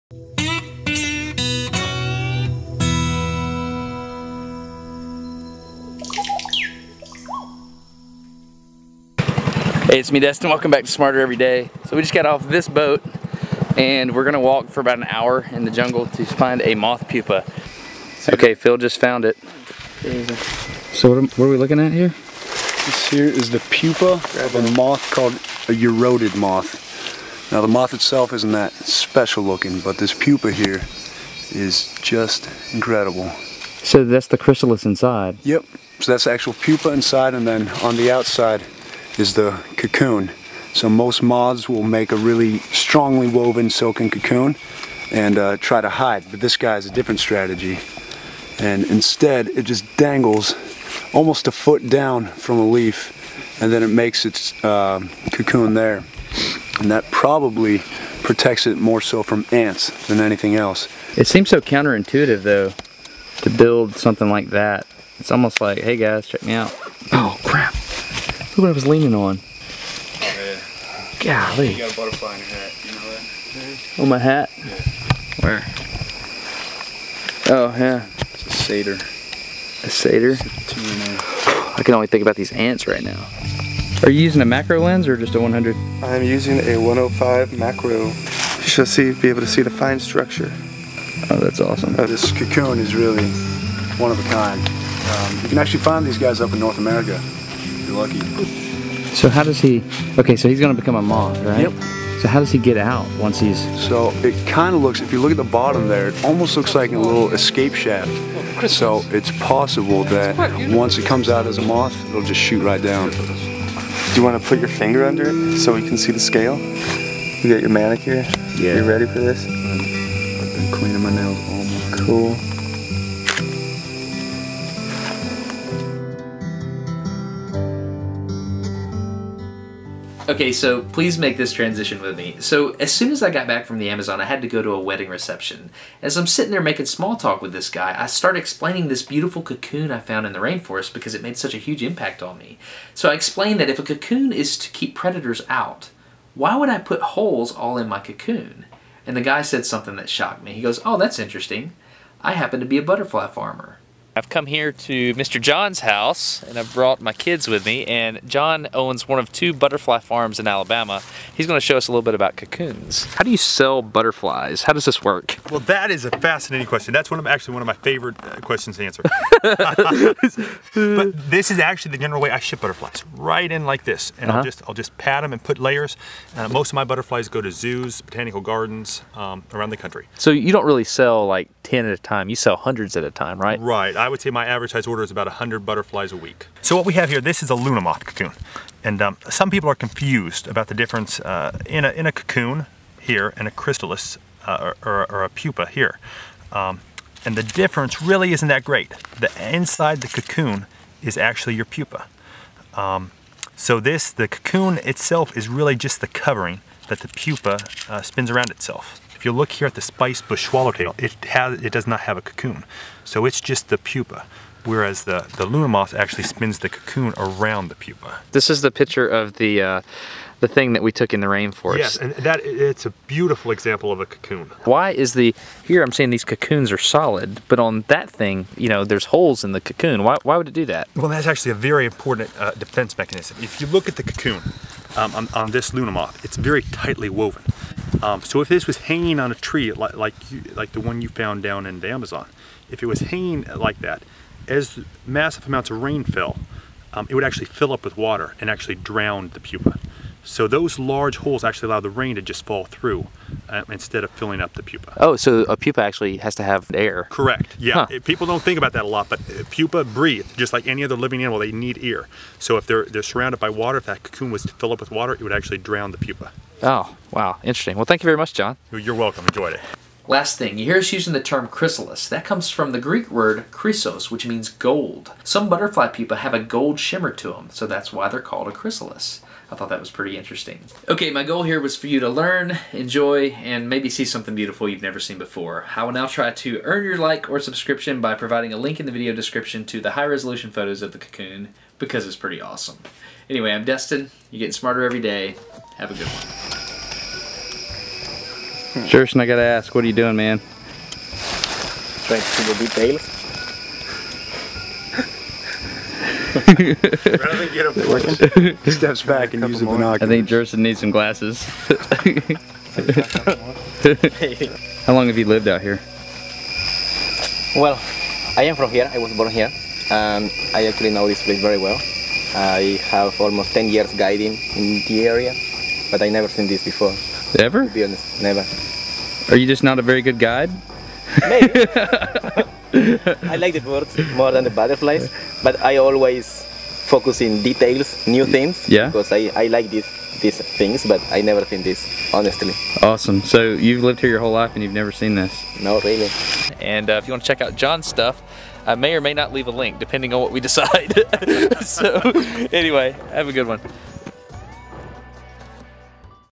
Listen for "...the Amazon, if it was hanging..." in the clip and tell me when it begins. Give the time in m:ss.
4:01.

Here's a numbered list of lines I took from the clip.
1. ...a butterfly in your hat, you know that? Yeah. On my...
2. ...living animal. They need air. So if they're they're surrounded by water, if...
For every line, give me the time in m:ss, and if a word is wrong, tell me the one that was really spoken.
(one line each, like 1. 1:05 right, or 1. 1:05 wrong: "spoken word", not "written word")
1. 1:11 right
2. 4:20 right.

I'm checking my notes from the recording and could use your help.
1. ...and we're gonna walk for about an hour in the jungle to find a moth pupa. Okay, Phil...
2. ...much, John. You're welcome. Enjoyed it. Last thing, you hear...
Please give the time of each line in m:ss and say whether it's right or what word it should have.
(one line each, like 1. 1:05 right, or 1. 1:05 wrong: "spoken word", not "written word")
1. 0:13 right
2. 4:28 right.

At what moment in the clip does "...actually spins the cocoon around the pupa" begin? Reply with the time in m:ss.
3:35.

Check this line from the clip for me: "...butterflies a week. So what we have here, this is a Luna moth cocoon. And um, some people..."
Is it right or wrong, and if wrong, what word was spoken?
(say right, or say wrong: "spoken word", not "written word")
right.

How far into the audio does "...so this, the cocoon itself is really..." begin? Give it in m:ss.
3:23.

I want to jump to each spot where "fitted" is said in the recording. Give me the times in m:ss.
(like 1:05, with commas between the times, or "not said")
not said.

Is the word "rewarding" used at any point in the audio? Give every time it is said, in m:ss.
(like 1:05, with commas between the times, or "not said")
not said.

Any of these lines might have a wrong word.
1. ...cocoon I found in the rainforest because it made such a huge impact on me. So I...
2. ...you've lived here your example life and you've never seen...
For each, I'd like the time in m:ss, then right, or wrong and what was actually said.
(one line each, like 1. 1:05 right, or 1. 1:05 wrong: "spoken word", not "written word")
1. 2:19 right
2. 5:43 wrong: "whole", not "example".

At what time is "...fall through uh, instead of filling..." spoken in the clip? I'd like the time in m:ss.
4:12.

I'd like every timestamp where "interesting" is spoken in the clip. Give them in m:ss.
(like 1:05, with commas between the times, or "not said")
2:31, 4:27, 4:40.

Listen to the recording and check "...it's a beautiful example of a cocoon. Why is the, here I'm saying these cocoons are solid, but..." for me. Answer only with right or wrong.
right.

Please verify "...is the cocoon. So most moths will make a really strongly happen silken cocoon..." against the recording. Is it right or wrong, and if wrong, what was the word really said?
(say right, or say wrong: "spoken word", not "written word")
wrong: "woven", not "happen".